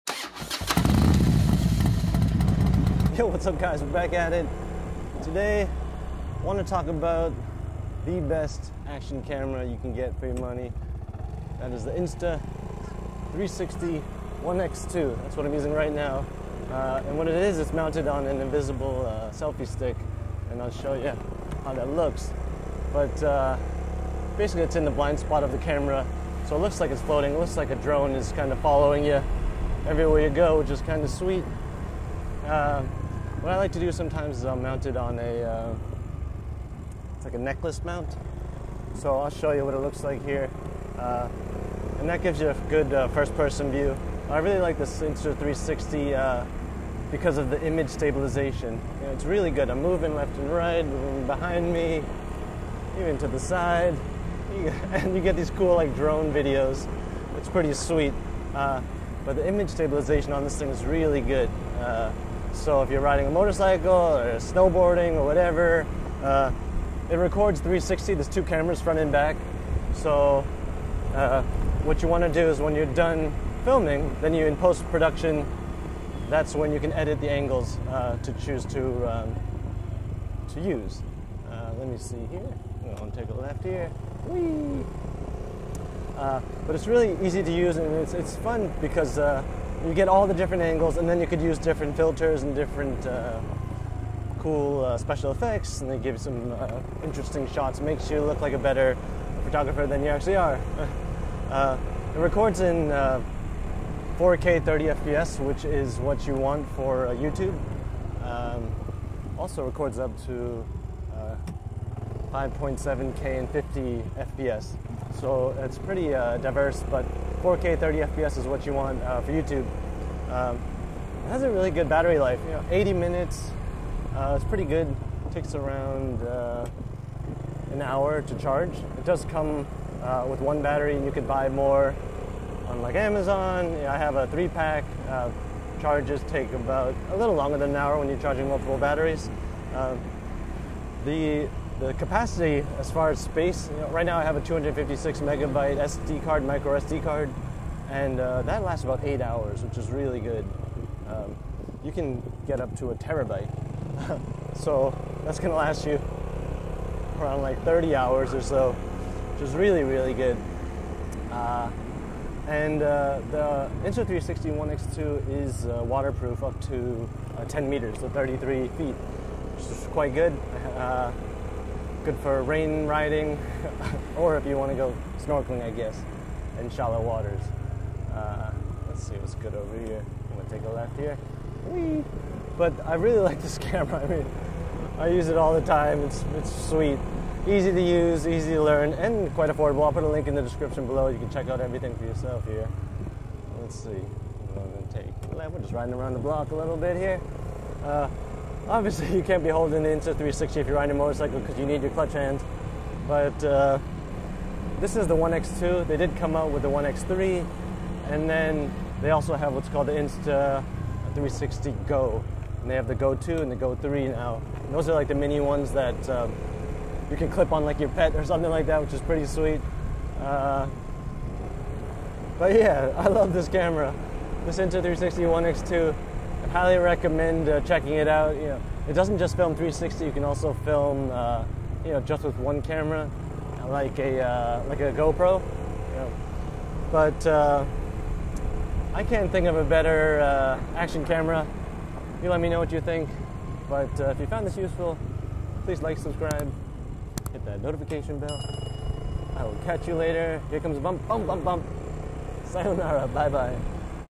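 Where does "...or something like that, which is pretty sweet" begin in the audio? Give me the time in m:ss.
3:38.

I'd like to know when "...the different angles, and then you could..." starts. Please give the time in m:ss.
1:30.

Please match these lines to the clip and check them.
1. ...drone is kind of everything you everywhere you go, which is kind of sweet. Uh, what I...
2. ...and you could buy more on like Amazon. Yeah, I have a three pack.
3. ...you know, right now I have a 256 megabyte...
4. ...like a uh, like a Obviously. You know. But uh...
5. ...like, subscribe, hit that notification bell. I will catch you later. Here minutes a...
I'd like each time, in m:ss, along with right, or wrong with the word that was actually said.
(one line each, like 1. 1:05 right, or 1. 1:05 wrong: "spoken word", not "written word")
1. 0:27 wrong: "following", not "everything"
2. 2:10 right
3. 2:23 right
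4. 3:53 wrong: "GoPro", not "Obviously"
5. 4:05 wrong: "comes", not "minutes".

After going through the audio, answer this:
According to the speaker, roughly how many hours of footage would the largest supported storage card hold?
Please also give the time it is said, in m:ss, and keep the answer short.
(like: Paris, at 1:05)
30 hours, at 2:37.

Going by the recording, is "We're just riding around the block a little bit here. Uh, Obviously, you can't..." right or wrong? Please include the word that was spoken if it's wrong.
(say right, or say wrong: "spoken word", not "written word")
right.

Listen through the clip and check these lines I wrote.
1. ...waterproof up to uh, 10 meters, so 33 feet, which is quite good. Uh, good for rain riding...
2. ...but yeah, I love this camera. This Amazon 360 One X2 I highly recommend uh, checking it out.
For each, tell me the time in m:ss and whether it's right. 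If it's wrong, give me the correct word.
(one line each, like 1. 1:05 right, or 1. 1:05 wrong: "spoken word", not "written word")
1. 2:45 right
2. 3:42 wrong: "Insta", not "Amazon".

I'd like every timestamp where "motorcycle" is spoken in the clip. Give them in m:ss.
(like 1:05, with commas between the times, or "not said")
1:03, 3:20.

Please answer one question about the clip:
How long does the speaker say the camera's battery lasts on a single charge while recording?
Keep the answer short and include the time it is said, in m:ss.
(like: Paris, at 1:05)
80 minutes, at 2:02.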